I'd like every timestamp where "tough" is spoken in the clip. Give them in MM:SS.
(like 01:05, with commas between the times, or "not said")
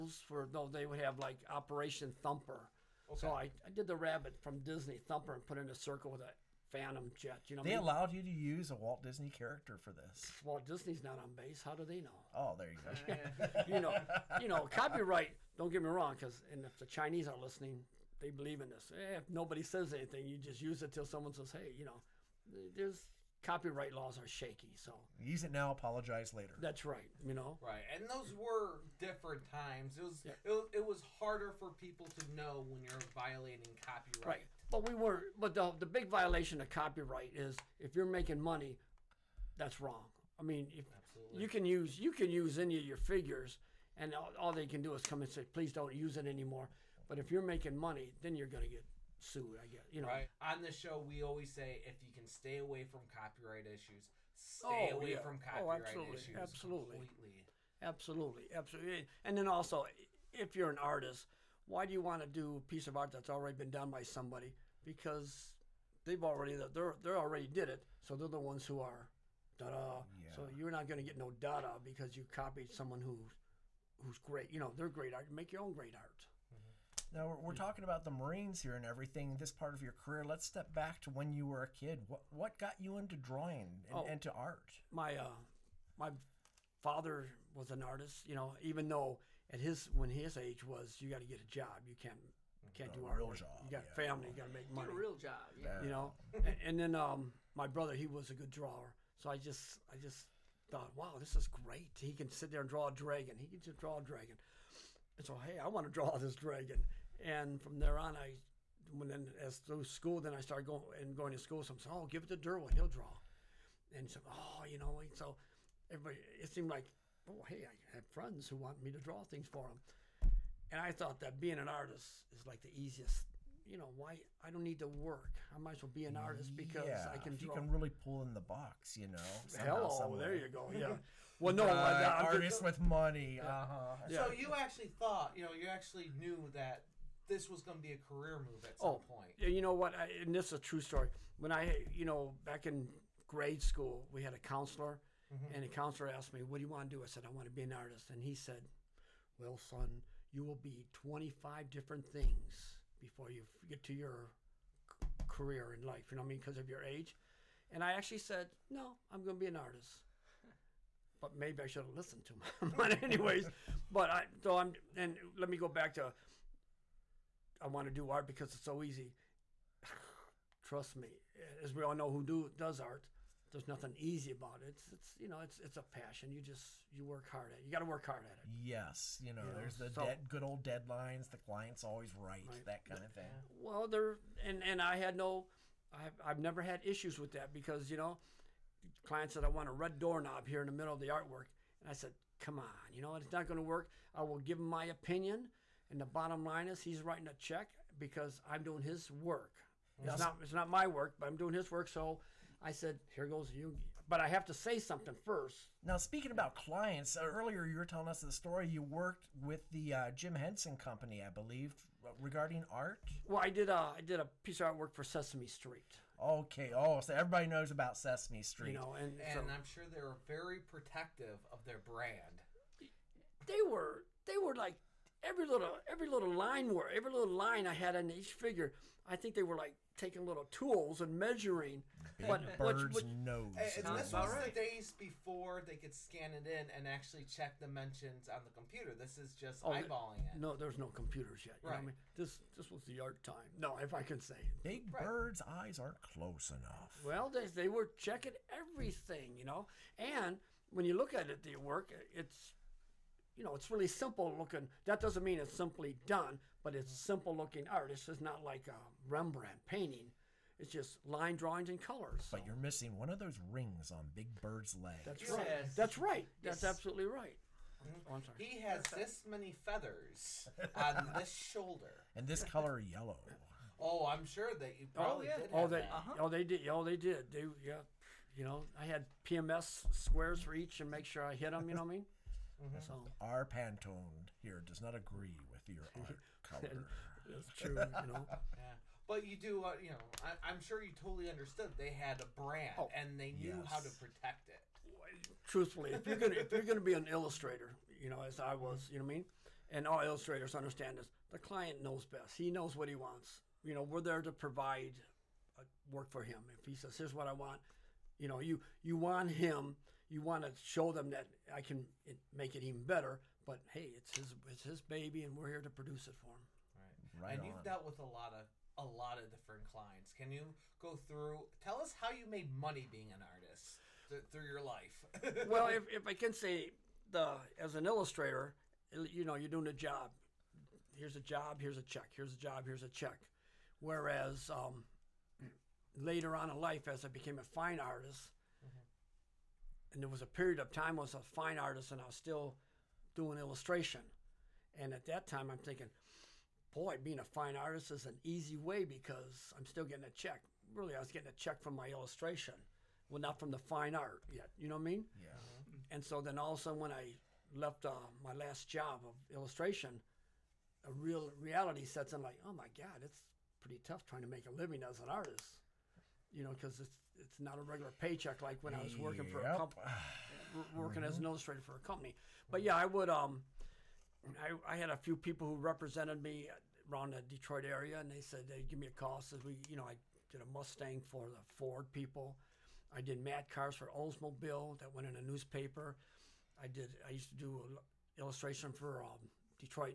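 06:03.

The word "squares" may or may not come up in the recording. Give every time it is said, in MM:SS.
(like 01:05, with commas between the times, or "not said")
04:39.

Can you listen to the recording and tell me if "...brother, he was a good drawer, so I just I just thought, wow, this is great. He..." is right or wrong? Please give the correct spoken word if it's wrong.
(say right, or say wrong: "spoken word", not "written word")
right.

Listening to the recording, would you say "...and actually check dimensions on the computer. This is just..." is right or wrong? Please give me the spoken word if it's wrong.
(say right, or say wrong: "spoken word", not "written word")
right.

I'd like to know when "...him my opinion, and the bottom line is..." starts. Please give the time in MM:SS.
03:14.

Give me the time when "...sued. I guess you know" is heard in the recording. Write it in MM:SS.
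00:49.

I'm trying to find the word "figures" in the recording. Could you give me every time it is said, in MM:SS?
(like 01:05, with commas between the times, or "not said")
00:42, 03:48.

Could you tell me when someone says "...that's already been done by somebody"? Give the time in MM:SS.
01:03.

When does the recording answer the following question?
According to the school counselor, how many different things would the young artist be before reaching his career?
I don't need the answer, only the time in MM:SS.
02:30.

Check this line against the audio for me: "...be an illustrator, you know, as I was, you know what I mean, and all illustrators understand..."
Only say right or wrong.
right.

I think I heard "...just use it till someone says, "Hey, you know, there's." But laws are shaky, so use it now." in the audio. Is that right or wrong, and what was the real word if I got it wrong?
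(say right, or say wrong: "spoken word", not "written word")
wrong: "Copyright", not "But".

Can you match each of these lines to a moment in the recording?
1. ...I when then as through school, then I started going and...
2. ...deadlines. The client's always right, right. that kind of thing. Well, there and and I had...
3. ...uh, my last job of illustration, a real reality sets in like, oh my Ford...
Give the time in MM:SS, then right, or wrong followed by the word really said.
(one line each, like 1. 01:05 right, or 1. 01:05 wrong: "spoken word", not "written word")
1. 01:48 right
2. 03:00 right
3. 05:57 wrong: "God", not "Ford".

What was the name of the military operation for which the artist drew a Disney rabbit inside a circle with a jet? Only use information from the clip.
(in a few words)
Operation Thumper.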